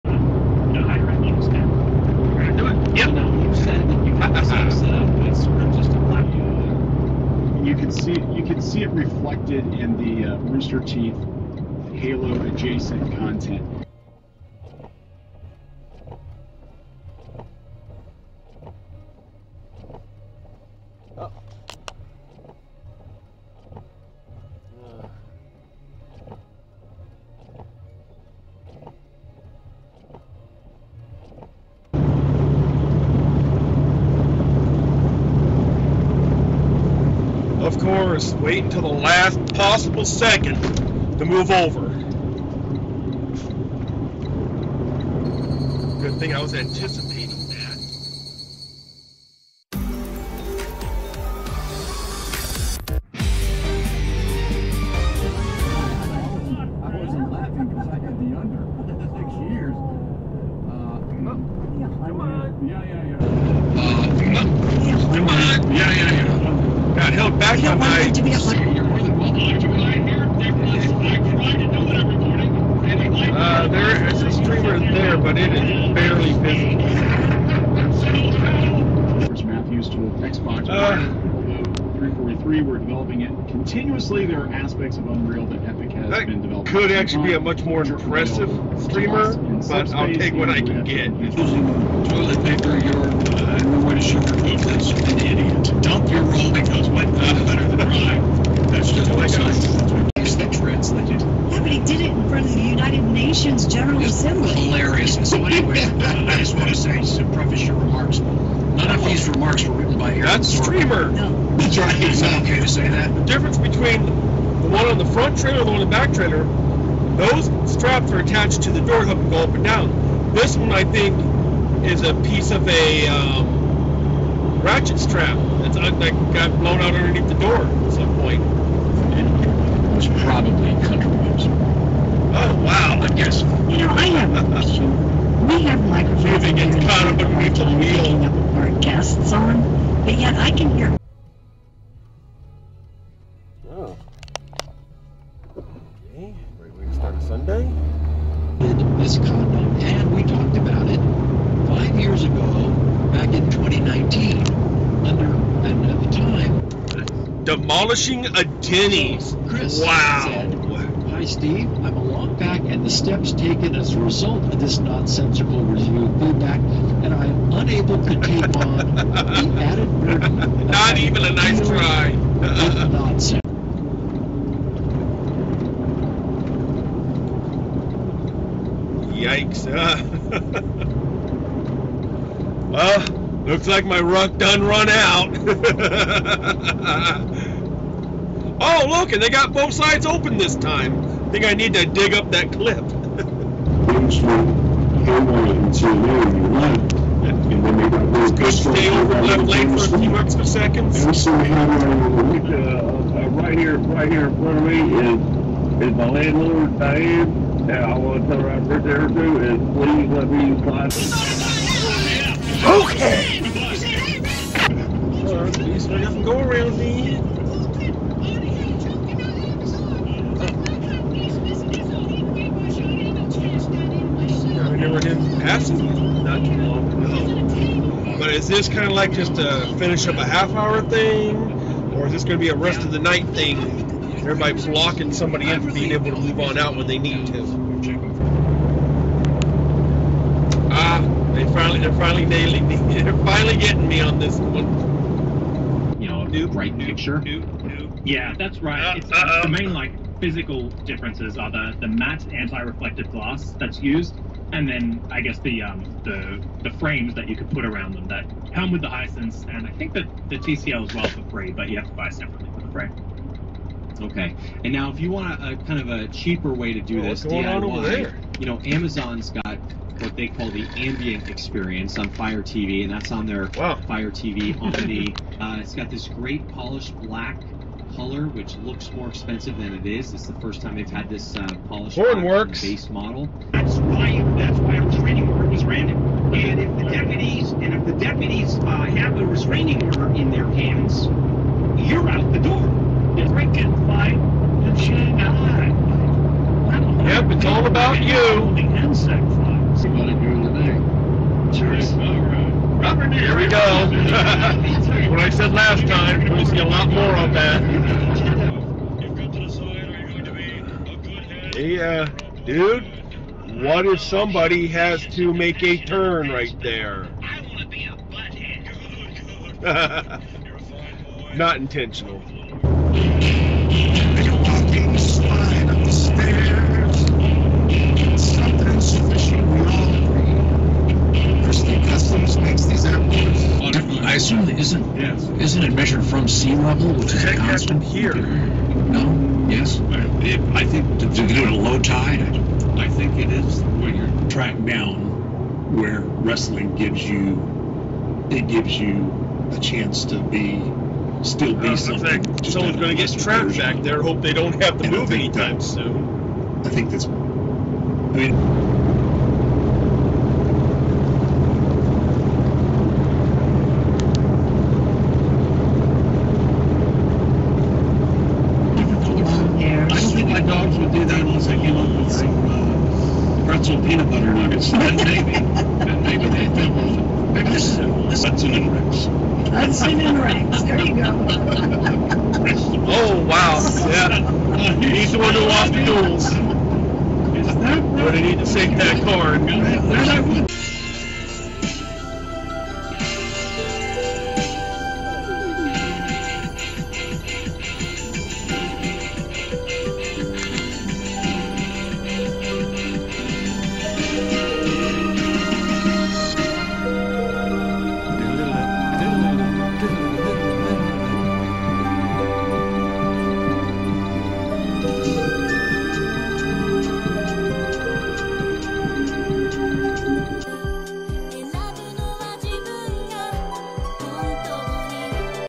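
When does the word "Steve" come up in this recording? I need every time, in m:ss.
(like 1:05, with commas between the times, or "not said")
2:41.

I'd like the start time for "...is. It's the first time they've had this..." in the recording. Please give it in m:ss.
4:39.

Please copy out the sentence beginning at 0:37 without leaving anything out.
course, wait until the last possible second to move over.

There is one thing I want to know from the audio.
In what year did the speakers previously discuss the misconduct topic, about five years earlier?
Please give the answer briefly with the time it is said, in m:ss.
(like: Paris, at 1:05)
2019, at 2:33.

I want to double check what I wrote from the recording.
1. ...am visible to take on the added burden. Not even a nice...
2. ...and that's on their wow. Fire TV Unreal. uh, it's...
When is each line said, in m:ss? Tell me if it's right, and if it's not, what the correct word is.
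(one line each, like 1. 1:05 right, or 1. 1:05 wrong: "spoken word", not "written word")
1. 2:47 wrong: "unable", not "visible"
2. 4:32 wrong: "Omni", not "Unreal".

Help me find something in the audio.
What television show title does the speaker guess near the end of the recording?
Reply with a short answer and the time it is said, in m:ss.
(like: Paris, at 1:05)
Hudson and Rex, at 6:18.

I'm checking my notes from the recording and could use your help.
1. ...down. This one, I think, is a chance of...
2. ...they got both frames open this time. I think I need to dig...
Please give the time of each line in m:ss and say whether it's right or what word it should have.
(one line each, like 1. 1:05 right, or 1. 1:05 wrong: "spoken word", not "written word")
1. 1:59 wrong: "piece", not "chance"
2. 3:09 wrong: "sides", not "frames".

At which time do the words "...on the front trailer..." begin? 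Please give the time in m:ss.
1:54.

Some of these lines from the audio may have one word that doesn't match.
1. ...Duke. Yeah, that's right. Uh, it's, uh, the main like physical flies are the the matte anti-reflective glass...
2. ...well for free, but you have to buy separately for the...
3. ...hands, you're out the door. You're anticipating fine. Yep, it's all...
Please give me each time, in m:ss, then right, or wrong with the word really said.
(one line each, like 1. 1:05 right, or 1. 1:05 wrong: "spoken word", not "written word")
1. 4:07 wrong: "differences", not "flies"
2. 4:20 right
3. 4:50 wrong: "freaking", not "anticipating".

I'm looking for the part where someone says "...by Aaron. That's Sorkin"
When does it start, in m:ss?
1:49.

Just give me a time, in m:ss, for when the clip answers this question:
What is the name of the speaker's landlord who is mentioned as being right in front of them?
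3:26.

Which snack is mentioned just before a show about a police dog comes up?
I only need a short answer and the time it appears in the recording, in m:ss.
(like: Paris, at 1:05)
pretzel peanut butter nuggets, at 6:13.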